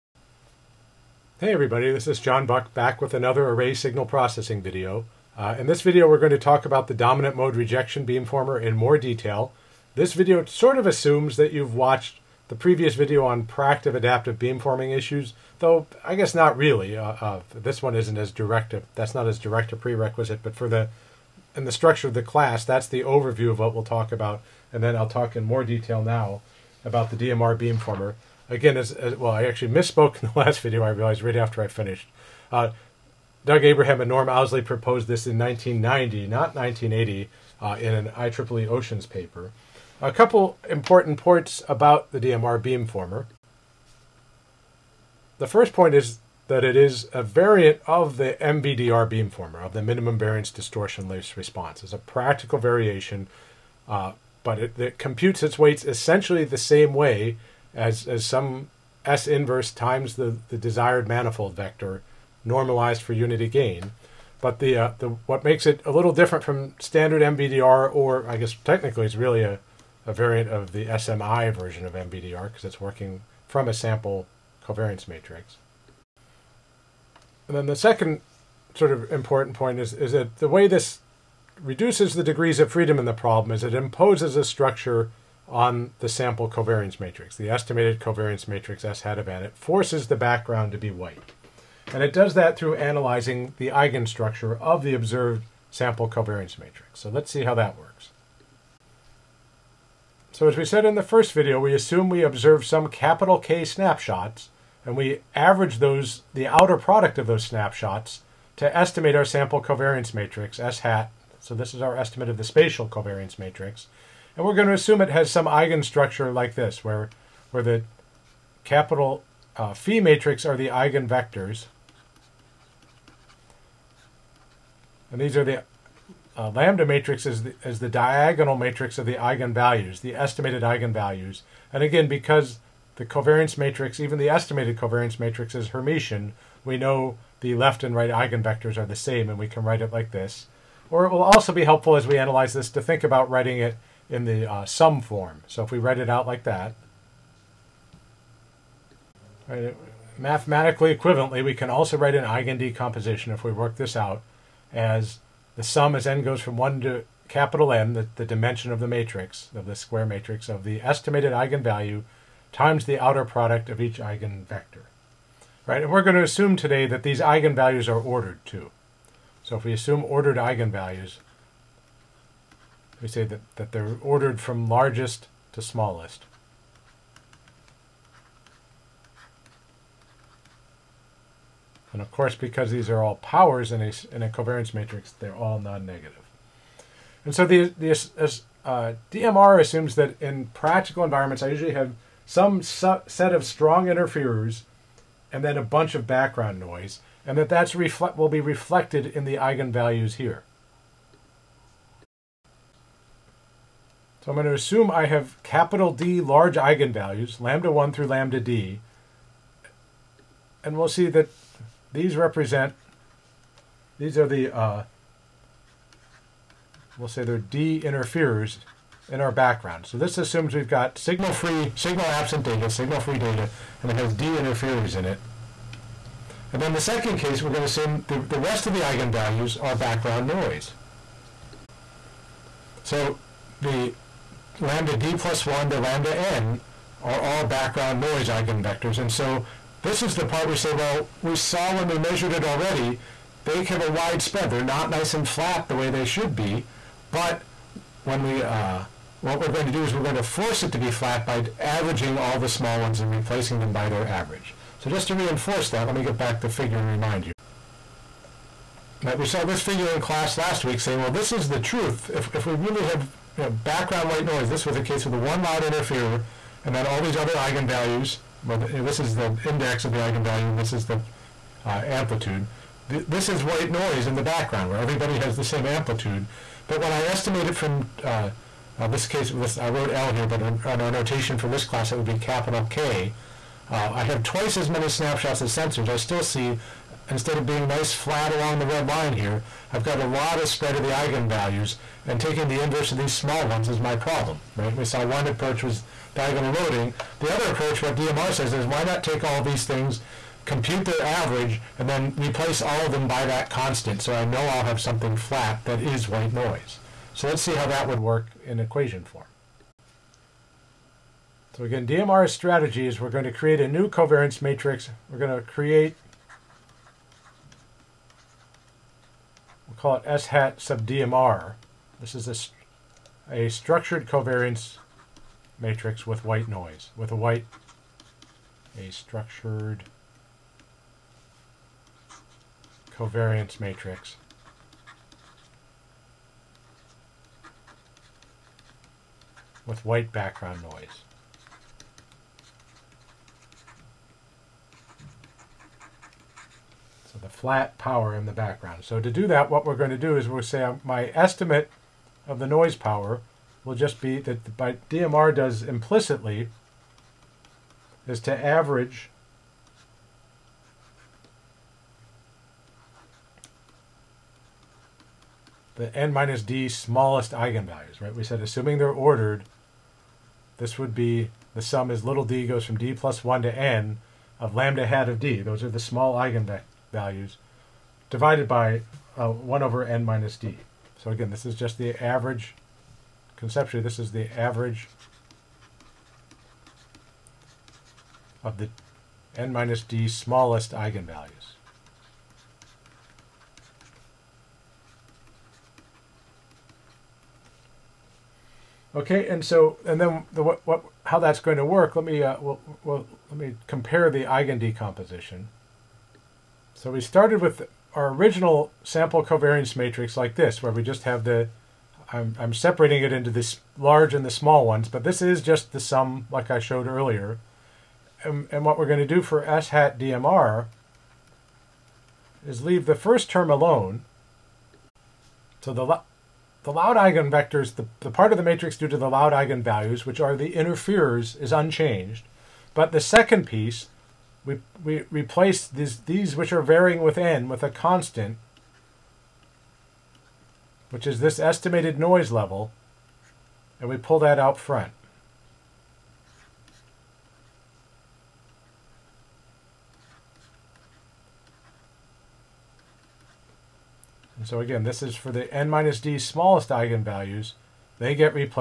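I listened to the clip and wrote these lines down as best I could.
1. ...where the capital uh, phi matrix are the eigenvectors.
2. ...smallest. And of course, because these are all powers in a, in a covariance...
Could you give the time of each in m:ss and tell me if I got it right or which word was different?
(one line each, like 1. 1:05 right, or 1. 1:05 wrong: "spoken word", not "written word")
1. 1:57 right
2. 2:55 right.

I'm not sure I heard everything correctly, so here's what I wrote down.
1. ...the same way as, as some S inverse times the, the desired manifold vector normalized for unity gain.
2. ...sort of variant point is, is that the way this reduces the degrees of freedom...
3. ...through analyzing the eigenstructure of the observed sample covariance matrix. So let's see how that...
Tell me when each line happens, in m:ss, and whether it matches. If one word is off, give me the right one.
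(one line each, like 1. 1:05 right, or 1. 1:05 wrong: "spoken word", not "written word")
1. 0:56 right
2. 1:18 wrong: "important", not "variant"
3. 1:32 right.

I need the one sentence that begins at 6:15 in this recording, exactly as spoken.
Those are the small eigenvalues divided by uh, 1 over n minus d.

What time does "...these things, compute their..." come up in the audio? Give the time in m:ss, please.
4:59.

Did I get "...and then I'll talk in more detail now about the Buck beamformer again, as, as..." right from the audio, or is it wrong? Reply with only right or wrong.
wrong.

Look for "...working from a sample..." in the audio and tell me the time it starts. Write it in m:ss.
1:12.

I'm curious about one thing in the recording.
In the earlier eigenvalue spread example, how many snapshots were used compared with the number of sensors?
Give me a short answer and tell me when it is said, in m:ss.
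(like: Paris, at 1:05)
twice as many, at 4:44.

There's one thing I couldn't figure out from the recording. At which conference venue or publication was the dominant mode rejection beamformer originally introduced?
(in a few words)
IEEE Oceans.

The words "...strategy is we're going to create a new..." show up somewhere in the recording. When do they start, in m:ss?
5:12.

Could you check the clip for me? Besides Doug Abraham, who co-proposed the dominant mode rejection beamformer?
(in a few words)
Norm Owsley.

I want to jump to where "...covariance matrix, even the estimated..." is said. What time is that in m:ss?
2:13.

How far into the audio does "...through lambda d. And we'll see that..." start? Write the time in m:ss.
3:27.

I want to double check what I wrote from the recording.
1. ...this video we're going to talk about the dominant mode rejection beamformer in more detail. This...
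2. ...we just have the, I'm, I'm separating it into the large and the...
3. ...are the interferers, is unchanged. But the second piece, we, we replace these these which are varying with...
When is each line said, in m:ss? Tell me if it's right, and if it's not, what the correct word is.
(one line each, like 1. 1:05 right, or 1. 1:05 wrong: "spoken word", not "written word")
1. 0:05 right
2. 6:50 right
3. 7:10 right.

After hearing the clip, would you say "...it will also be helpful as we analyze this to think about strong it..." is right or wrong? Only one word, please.
wrong.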